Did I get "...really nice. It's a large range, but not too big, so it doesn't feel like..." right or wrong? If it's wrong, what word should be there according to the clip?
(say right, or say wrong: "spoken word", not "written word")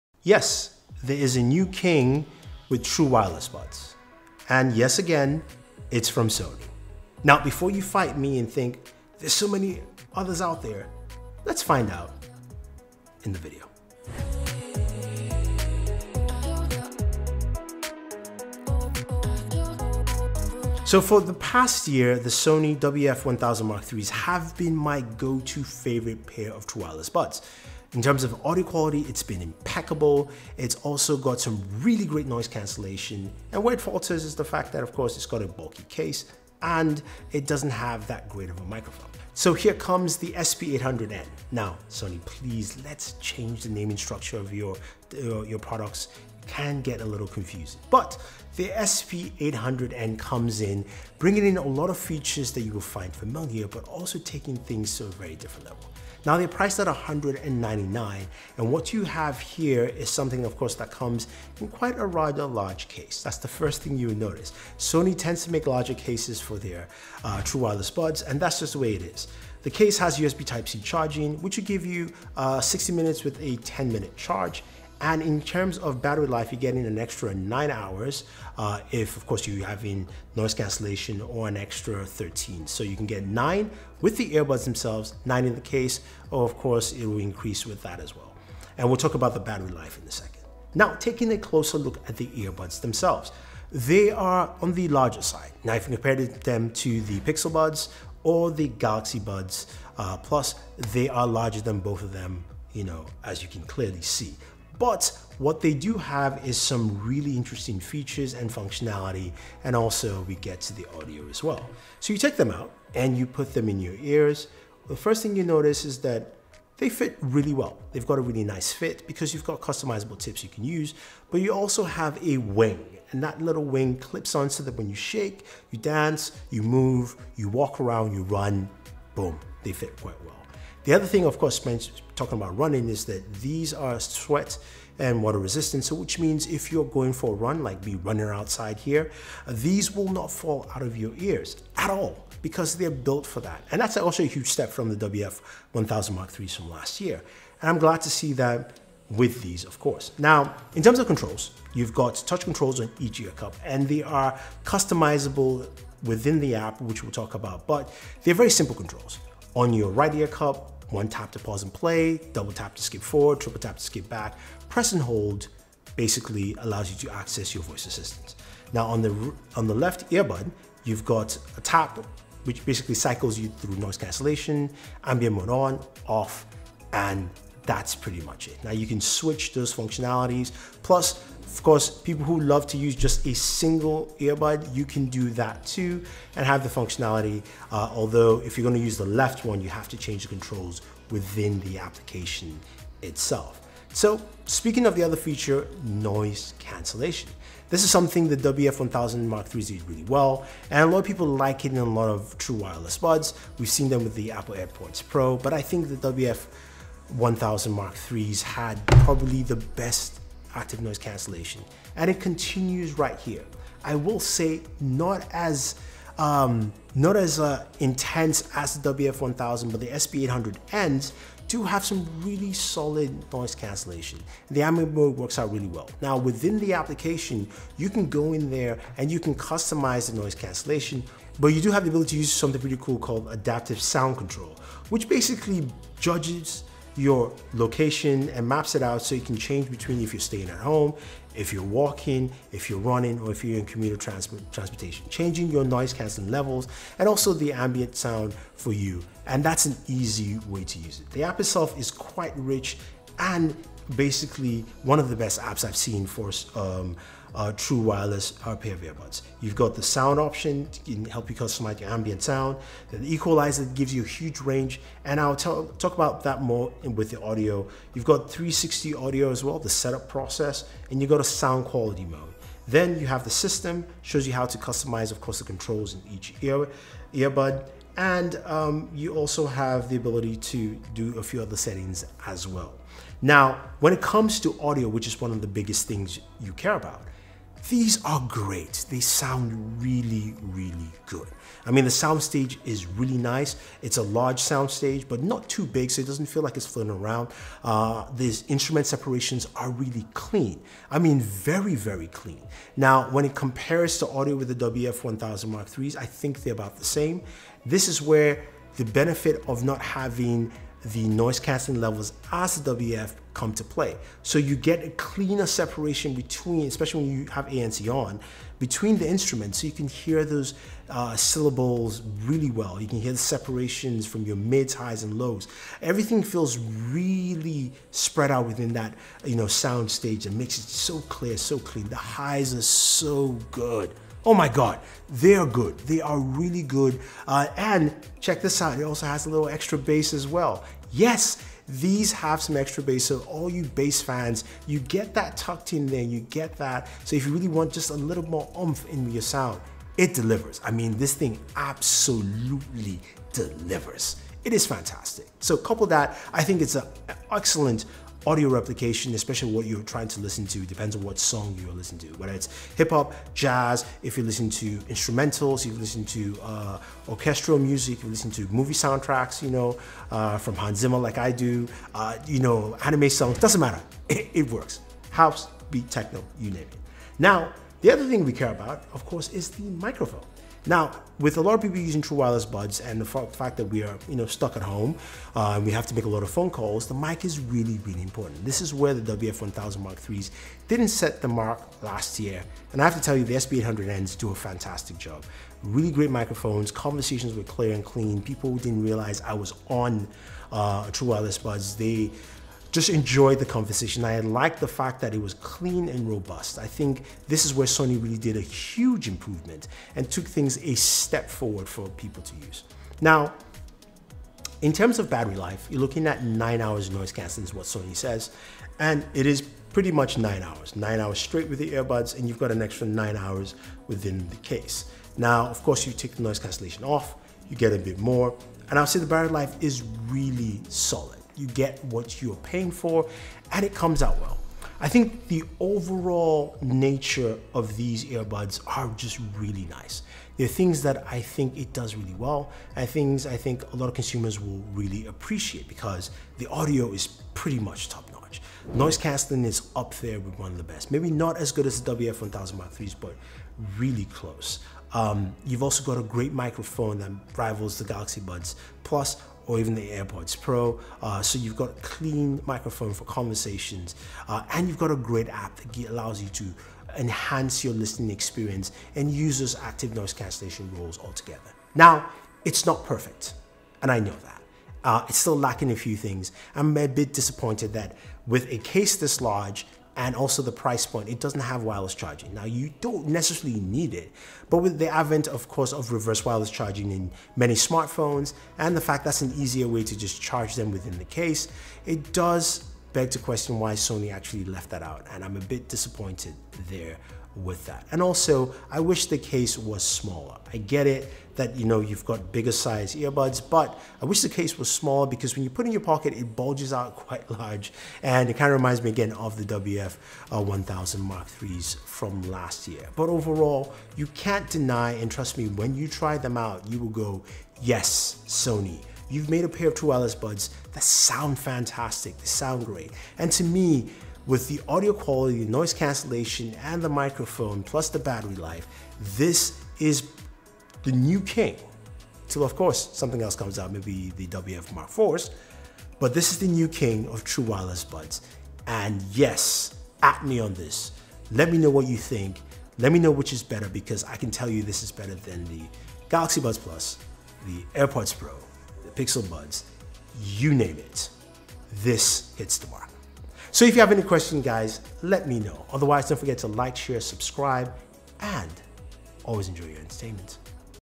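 wrong: "soundstage", not "range".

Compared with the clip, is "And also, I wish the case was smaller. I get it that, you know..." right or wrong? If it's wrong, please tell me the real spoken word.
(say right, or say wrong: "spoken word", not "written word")
right.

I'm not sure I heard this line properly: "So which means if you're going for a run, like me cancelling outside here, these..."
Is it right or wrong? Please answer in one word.
wrong.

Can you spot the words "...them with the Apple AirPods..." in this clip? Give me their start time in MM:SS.
03:23.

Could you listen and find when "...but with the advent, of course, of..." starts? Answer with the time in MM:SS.
08:04.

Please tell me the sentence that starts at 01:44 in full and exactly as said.
But what they do have is some really interesting features and functionality, and also we get to the audio as well.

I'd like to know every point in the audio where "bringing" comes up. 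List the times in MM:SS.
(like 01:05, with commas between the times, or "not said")
00:51.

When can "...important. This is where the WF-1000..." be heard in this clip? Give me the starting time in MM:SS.
06:28.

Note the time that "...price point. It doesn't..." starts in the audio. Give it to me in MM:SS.
08:00.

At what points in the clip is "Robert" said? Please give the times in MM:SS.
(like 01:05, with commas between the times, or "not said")
not said.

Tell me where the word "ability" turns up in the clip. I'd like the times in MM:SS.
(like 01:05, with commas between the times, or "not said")
03:51, 04:39.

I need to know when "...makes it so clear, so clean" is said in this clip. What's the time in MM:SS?
05:30.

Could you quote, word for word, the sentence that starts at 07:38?
Plus, or even the AirPods Pro.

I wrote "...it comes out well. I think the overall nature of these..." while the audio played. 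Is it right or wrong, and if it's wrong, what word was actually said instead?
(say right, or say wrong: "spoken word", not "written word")
right.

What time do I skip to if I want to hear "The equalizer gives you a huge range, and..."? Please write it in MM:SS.
04:22.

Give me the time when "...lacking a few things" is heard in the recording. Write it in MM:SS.
07:55.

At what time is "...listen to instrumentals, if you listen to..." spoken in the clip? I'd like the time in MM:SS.
06:04.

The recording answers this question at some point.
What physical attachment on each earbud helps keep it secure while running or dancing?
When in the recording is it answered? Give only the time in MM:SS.
02:02.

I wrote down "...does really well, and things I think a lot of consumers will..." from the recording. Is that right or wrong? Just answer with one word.
right.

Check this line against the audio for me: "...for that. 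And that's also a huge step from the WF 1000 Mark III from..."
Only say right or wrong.
right.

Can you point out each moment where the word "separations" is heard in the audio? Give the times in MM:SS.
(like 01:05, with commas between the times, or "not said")
04:58, 05:15, 05:23.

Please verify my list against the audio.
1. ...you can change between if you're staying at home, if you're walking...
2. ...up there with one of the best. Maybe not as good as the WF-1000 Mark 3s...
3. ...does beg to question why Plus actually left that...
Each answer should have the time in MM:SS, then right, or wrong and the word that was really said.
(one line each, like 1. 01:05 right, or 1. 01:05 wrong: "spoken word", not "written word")
1. 03:59 right
2. 07:29 right
3. 08:12 wrong: "Sony", not "Plus".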